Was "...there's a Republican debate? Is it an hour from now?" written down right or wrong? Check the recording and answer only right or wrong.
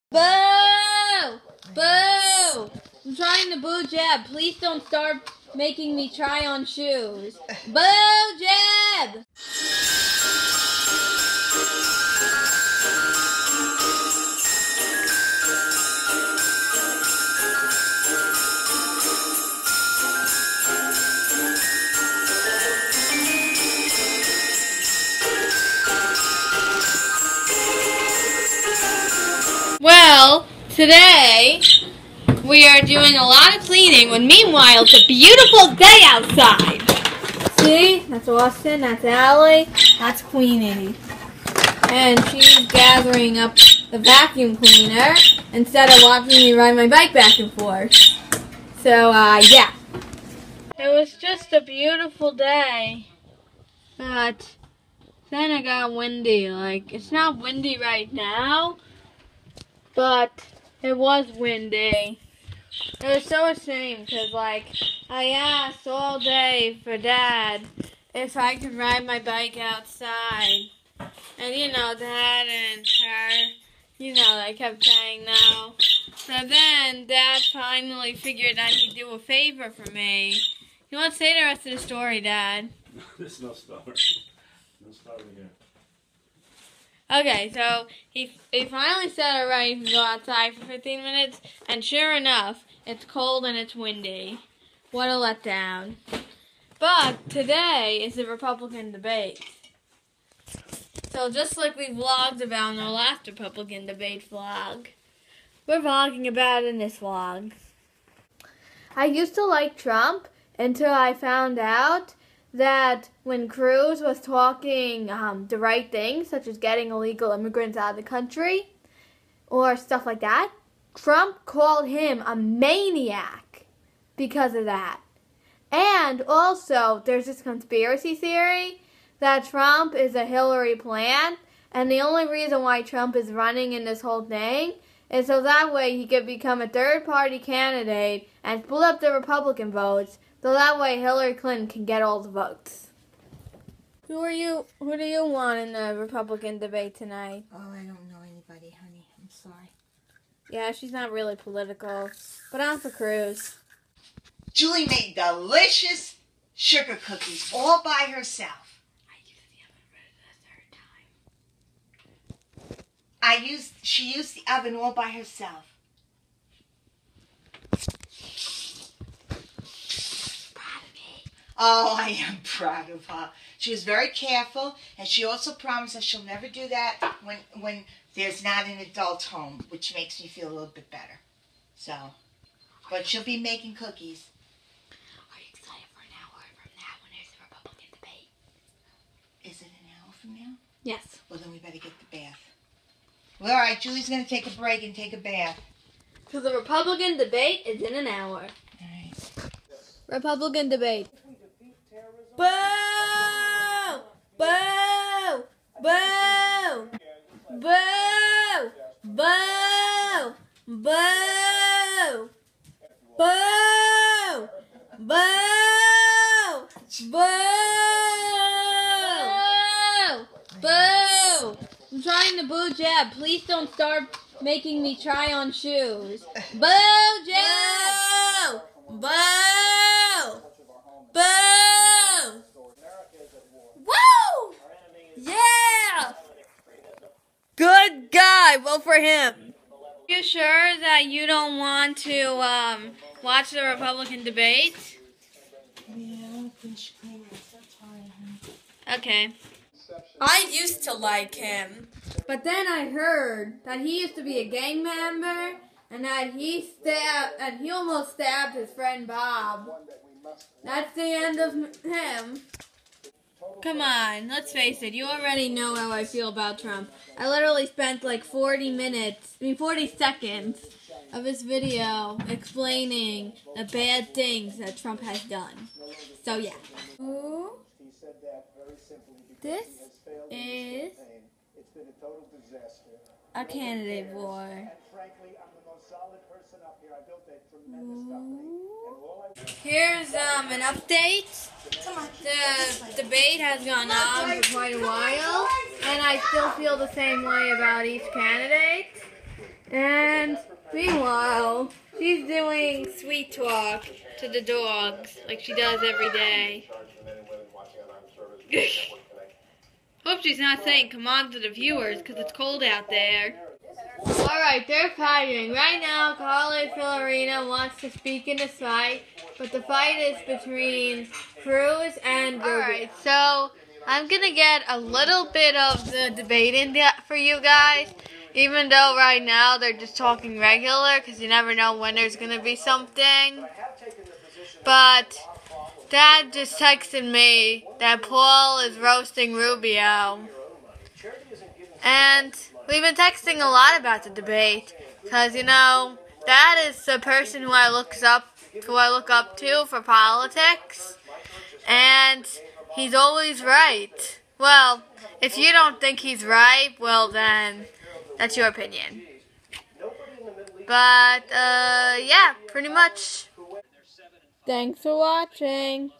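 right.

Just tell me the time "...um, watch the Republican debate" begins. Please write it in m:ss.
4:02.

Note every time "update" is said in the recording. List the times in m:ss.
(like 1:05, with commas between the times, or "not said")
4:50.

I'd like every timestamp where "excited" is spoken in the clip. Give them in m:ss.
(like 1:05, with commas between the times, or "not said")
3:05.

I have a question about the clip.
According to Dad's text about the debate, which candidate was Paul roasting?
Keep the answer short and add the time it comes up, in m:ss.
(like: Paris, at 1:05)
Rubio, at 5:39.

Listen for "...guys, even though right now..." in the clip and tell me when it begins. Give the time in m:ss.
5:27.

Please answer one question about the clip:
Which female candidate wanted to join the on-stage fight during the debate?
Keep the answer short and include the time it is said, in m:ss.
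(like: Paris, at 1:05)
Carly Fiorina, at 5:16.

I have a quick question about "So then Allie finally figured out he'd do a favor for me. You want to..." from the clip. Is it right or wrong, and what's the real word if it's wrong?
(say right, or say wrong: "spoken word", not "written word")
wrong: "Dad", not "Allie".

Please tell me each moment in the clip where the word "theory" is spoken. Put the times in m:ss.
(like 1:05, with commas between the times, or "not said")
2:08.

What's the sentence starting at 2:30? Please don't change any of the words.
Yeah, she's not really political, but I'm for Cruz.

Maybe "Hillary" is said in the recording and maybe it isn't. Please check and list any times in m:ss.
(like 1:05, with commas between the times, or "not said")
2:10, 2:20.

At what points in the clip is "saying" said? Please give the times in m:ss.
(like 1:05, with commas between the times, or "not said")
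1:14, 5:10.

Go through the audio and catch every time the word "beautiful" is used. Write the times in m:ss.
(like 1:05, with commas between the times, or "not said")
0:35, 0:51.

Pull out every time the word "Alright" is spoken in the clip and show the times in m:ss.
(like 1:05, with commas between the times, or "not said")
5:14, 5:22.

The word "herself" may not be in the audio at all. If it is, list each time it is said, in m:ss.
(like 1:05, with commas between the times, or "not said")
2:38, 2:45.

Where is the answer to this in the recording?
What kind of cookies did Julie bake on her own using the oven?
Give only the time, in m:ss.
2:36.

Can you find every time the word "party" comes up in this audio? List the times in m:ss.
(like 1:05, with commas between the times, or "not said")
2:17.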